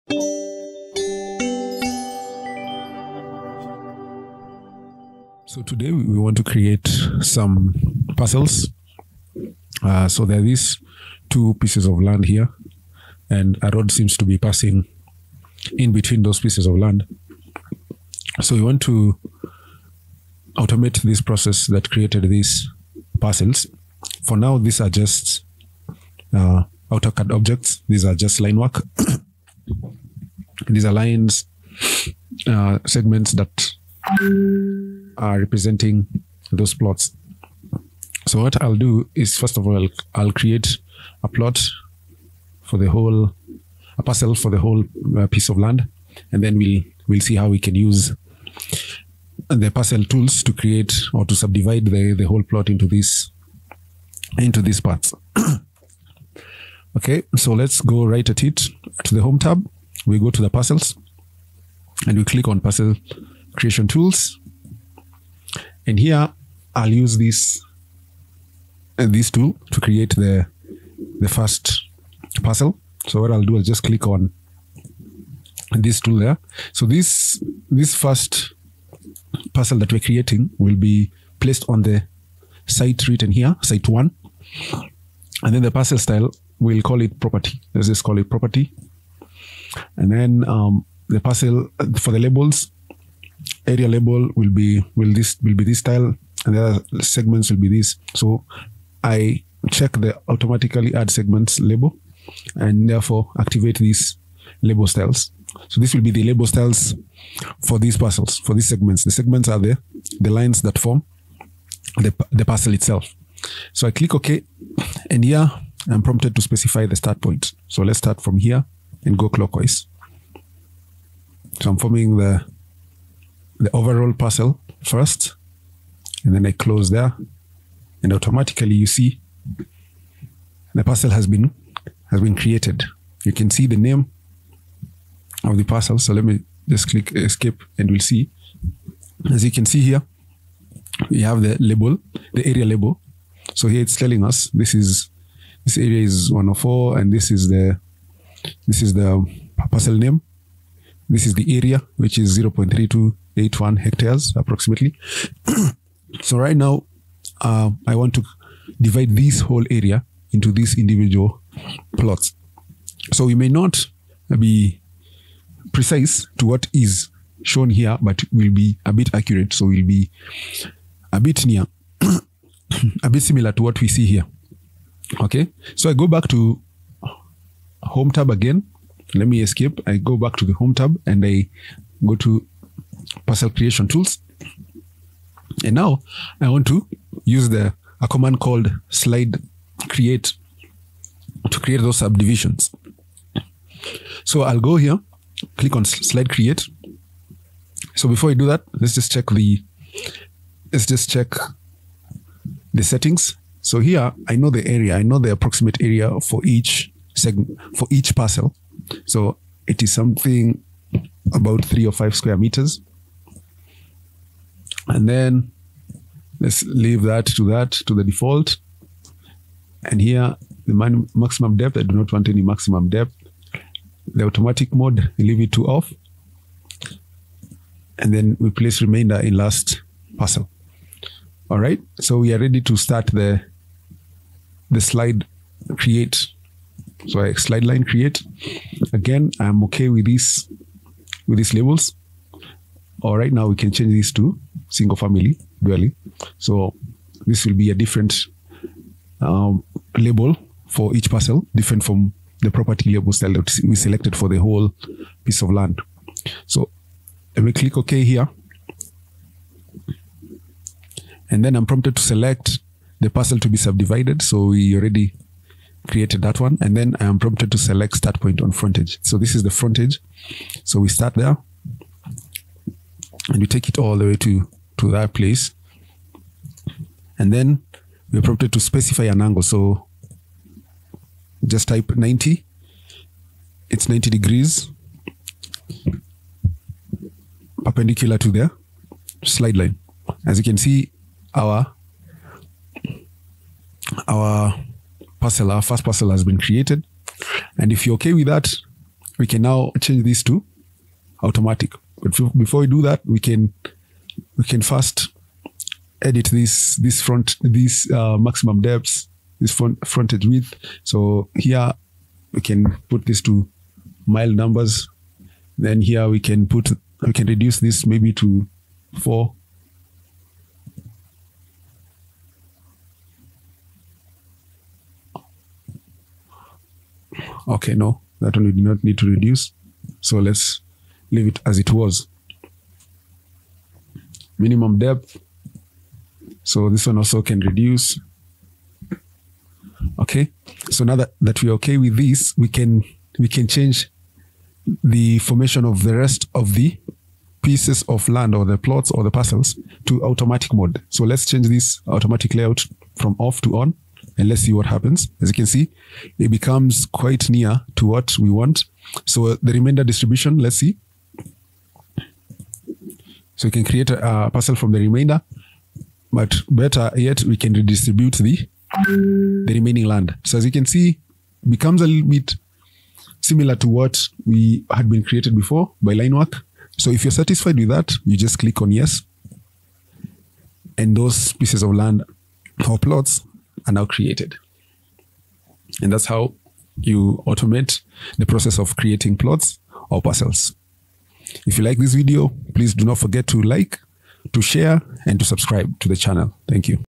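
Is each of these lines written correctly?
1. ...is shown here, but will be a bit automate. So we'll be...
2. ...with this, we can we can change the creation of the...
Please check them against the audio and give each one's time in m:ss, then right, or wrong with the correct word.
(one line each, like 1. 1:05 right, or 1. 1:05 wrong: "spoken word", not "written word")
1. 2:46 wrong: "accurate", not "automate"
2. 5:41 wrong: "formation", not "creation".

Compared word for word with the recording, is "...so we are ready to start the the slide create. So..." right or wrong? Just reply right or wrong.
right.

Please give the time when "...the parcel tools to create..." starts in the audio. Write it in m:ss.
0:49.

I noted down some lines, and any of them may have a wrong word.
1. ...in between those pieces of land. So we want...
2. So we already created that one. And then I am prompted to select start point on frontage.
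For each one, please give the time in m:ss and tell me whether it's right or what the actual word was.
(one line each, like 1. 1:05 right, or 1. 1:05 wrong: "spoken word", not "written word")
1. 0:15 right
2. 4:24 right.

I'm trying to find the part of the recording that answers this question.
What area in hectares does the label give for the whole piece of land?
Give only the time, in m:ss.
2:32.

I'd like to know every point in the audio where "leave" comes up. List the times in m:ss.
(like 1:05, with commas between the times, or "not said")
3:36, 3:45, 5:31.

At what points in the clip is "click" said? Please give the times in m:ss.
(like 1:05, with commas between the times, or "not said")
1:02, 1:13, 1:53, 2:16, 3:15, 4:17, 6:18.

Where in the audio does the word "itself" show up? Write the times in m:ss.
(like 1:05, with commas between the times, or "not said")
1:52.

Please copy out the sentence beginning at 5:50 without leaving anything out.
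So let's change this automatic layout from off to on and let's see what happens.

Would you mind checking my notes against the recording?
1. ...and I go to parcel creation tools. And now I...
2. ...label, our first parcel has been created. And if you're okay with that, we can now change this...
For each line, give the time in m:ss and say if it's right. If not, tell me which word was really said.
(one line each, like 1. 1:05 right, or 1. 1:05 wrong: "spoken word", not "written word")
1. 3:01 right
2. 4:55 wrong: "parcel", not "label".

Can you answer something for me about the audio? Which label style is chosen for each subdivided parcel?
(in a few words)
Single family dwelling.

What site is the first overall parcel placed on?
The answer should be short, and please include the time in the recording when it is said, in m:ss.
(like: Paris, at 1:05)
Site one, at 1:23.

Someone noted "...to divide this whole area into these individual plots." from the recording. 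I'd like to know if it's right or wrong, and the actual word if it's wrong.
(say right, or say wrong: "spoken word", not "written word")
right.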